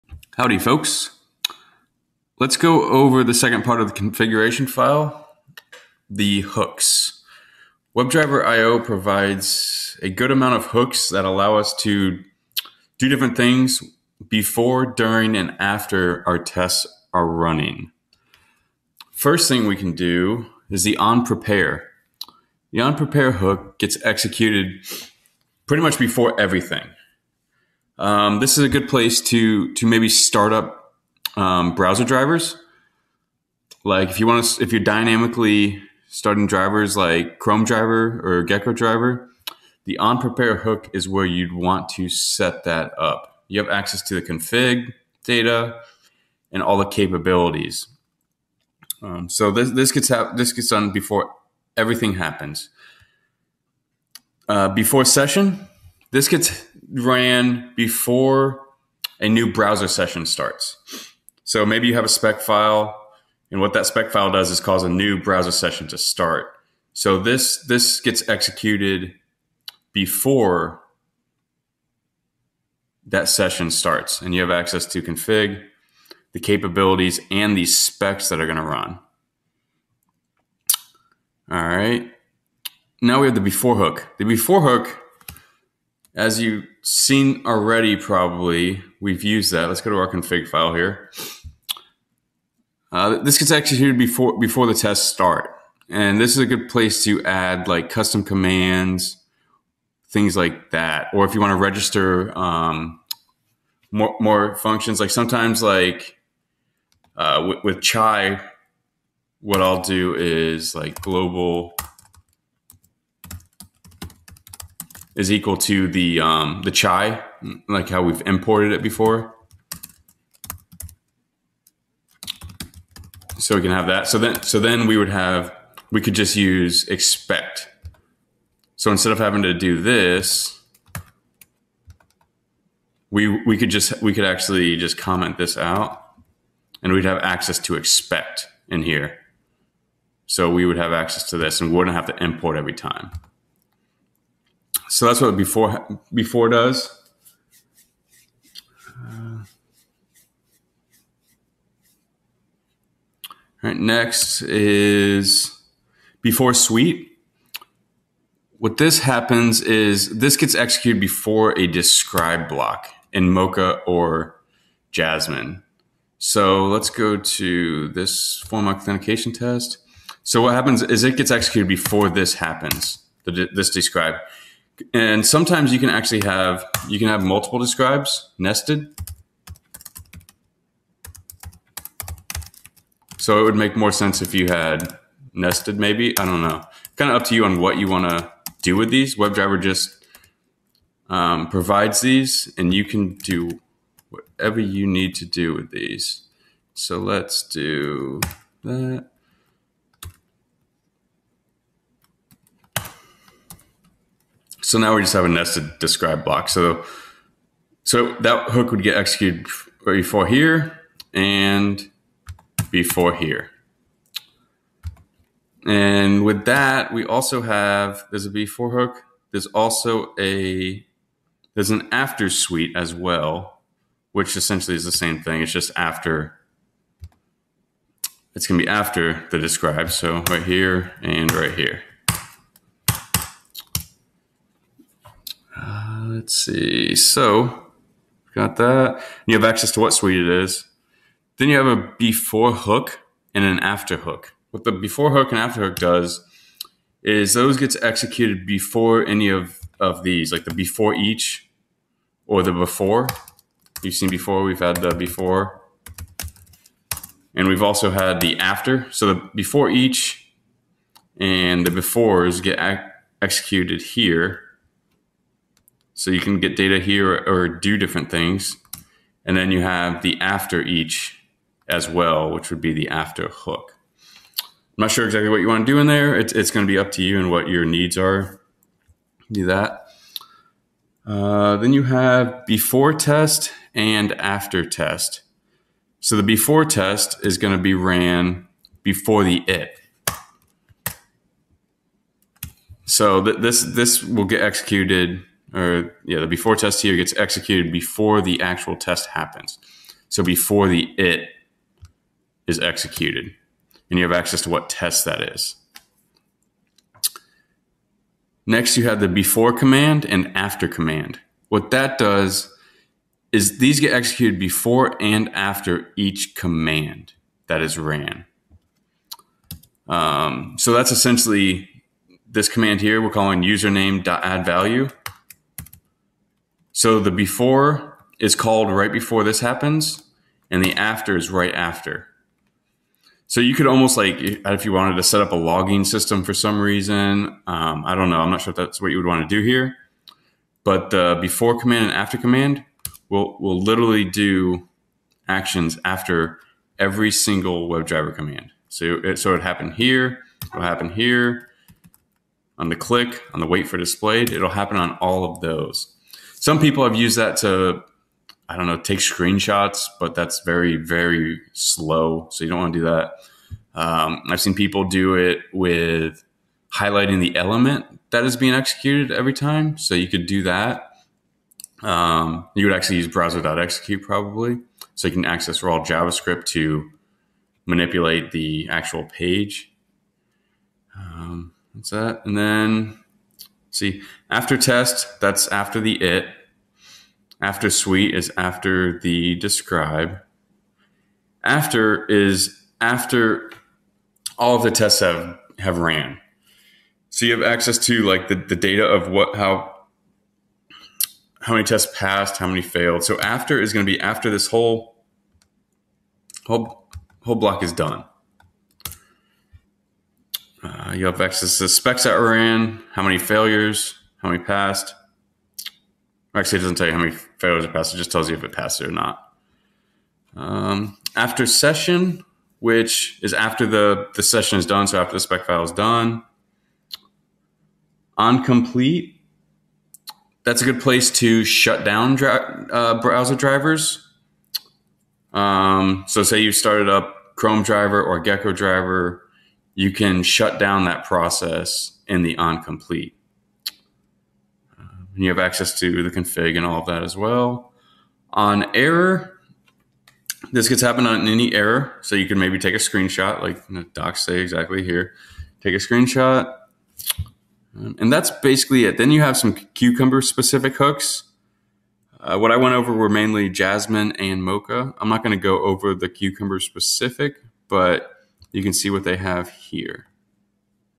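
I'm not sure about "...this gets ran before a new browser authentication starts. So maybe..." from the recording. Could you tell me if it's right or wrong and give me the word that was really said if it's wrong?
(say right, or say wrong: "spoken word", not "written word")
wrong: "session", not "authentication".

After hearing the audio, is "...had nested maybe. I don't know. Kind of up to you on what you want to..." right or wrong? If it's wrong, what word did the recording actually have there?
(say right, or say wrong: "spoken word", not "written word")
right.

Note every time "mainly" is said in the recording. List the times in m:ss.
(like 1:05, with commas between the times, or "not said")
7:43.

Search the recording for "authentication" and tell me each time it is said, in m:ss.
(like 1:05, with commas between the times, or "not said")
2:48.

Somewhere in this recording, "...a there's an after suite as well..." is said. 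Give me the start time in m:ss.
3:40.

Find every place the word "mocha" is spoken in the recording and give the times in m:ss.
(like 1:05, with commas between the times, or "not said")
2:43, 7:44.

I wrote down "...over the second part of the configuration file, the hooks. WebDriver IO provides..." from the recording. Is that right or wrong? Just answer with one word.
right.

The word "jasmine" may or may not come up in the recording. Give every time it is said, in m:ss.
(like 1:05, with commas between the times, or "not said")
2:44, 7:43.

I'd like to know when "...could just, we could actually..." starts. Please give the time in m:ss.
2:13.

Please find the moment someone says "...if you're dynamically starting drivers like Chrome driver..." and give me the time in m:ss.
0:34.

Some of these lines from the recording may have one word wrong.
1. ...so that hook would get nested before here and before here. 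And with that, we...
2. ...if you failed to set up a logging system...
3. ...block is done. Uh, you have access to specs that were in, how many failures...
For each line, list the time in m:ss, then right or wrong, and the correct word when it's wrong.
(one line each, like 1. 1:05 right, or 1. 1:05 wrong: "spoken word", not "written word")
1. 3:27 wrong: "executed", not "nested"
2. 5:34 wrong: "wanted", not "failed"
3. 6:47 right.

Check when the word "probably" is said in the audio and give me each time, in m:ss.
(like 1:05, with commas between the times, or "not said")
1:27, 6:14.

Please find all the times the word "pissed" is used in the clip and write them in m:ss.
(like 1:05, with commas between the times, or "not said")
not said.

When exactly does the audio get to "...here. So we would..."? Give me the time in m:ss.
2:18.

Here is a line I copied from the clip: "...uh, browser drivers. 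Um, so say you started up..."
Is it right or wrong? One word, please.
right.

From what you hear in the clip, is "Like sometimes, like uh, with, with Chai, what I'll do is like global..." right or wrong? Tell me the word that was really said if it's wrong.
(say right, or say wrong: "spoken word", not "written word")
right.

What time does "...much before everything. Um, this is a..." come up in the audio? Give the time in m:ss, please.
0:25.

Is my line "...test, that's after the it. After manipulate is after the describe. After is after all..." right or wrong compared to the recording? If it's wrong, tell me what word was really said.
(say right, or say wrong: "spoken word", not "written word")
wrong: "suite", not "manipulate".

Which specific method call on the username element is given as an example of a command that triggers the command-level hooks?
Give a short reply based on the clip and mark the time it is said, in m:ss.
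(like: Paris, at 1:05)
username.addValue, at 5:23.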